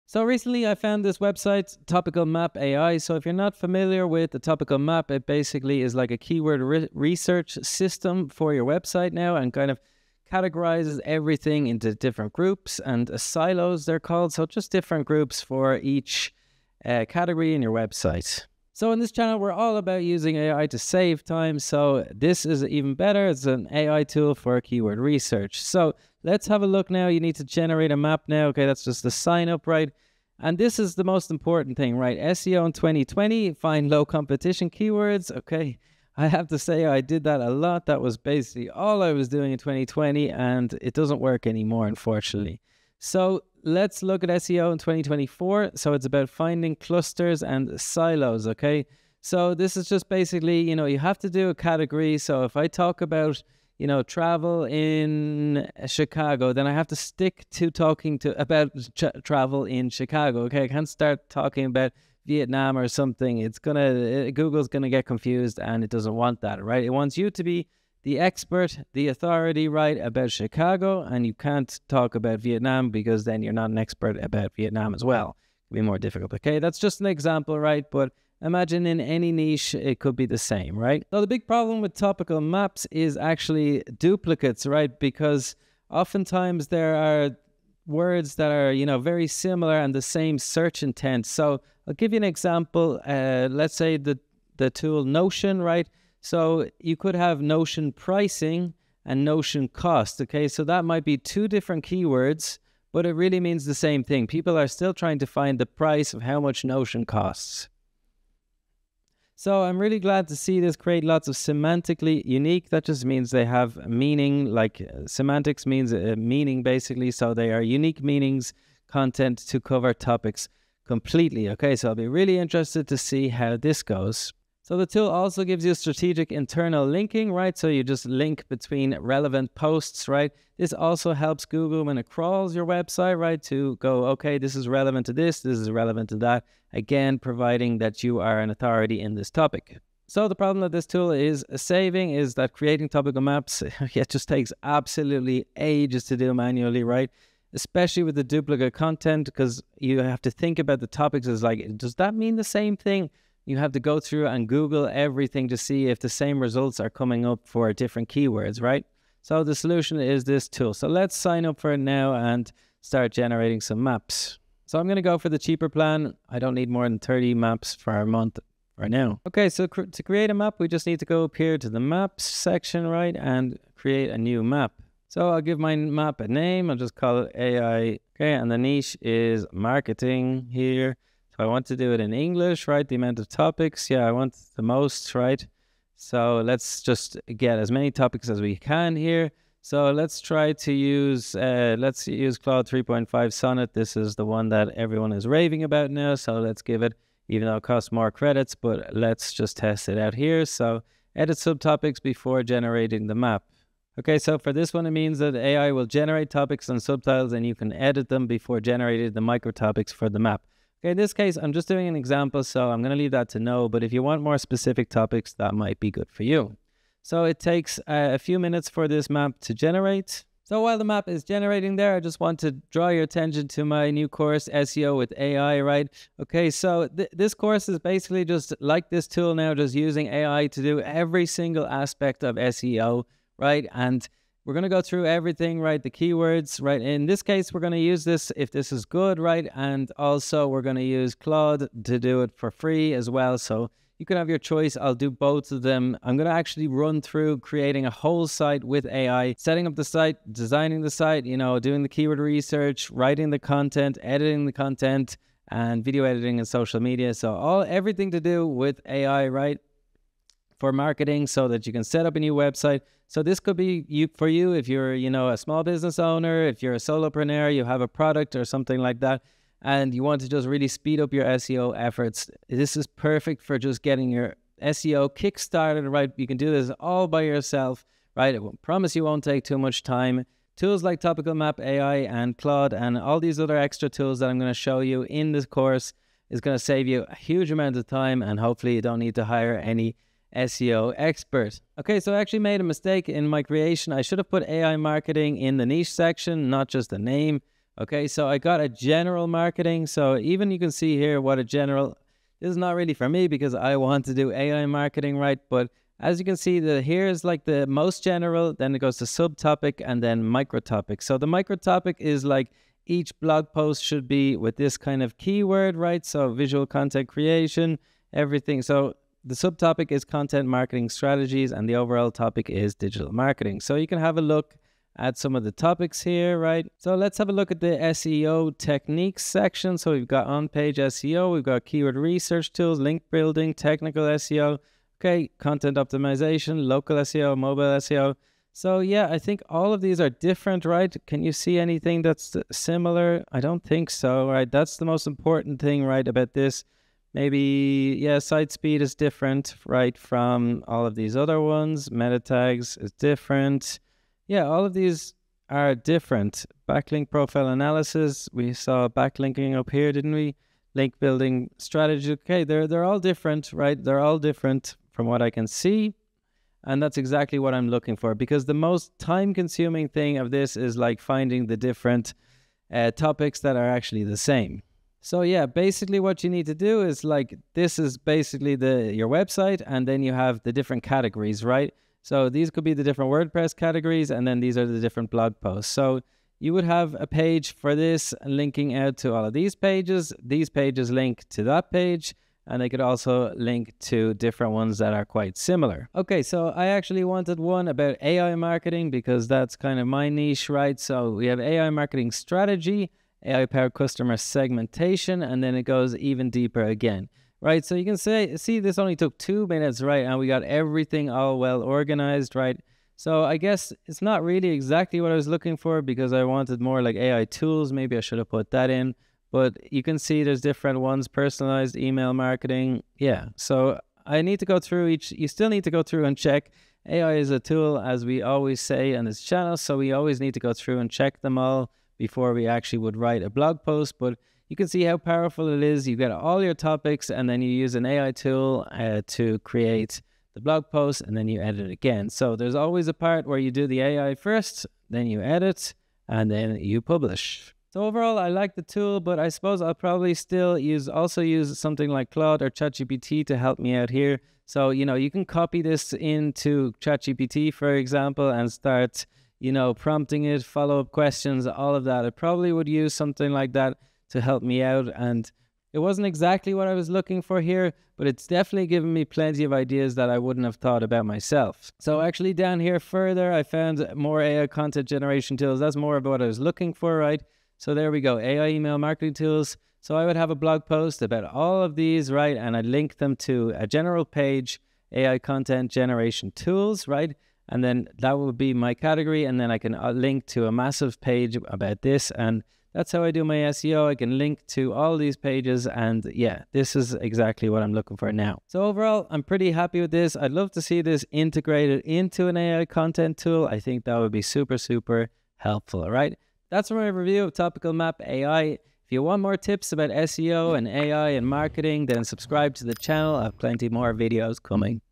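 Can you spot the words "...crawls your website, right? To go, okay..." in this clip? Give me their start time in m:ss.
2:12.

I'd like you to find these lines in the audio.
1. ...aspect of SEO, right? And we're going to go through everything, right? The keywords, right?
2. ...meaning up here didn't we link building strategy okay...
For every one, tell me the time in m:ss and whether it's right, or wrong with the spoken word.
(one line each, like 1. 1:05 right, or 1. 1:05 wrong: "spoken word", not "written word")
1. 3:51 right
2. 5:58 wrong: "backlinking", not "meaning".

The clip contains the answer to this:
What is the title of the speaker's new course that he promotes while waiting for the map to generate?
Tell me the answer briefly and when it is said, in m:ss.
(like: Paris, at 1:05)
SEO with AI, at 3:44.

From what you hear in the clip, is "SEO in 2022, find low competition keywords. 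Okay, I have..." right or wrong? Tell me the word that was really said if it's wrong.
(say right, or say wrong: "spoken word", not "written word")
wrong: "2020", not "2022".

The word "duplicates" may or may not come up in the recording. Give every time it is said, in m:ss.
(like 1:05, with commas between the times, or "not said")
1:23, 2:28.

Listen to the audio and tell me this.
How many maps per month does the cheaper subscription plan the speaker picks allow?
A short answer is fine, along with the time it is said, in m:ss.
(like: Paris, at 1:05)
30, at 2:46.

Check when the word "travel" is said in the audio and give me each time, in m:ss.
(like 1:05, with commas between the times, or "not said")
0:54, 0:59.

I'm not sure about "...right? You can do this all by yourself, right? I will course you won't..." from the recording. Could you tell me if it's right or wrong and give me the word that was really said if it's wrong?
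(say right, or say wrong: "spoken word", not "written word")
wrong: "promise", not "course".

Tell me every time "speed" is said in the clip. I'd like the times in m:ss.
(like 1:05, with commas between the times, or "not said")
4:30, 5:48.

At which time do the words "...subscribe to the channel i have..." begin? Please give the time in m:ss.
8:32.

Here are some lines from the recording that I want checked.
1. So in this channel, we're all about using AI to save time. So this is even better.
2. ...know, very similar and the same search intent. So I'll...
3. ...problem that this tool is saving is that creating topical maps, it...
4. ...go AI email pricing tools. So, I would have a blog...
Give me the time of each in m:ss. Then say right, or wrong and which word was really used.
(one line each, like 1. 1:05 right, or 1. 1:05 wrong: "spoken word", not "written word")
1. 0:18 right
2. 1:28 right
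3. 2:20 right
4. 7:57 wrong: "marketing", not "pricing".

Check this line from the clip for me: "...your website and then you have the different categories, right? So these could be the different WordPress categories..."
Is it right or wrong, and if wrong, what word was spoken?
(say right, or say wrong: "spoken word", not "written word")
right.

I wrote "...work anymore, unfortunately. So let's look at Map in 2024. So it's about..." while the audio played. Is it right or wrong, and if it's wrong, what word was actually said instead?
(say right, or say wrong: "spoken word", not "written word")
wrong: "SEO", not "Map".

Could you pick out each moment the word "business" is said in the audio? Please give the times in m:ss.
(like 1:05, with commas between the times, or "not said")
4:25.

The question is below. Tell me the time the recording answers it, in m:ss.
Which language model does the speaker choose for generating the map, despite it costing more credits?
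3:12.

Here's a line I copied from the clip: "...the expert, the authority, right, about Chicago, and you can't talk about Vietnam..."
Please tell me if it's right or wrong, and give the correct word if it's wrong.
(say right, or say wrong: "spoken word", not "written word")
right.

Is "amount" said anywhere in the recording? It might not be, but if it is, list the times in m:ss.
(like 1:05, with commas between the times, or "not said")
3:02, 4:47.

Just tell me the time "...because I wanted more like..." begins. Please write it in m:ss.
6:55.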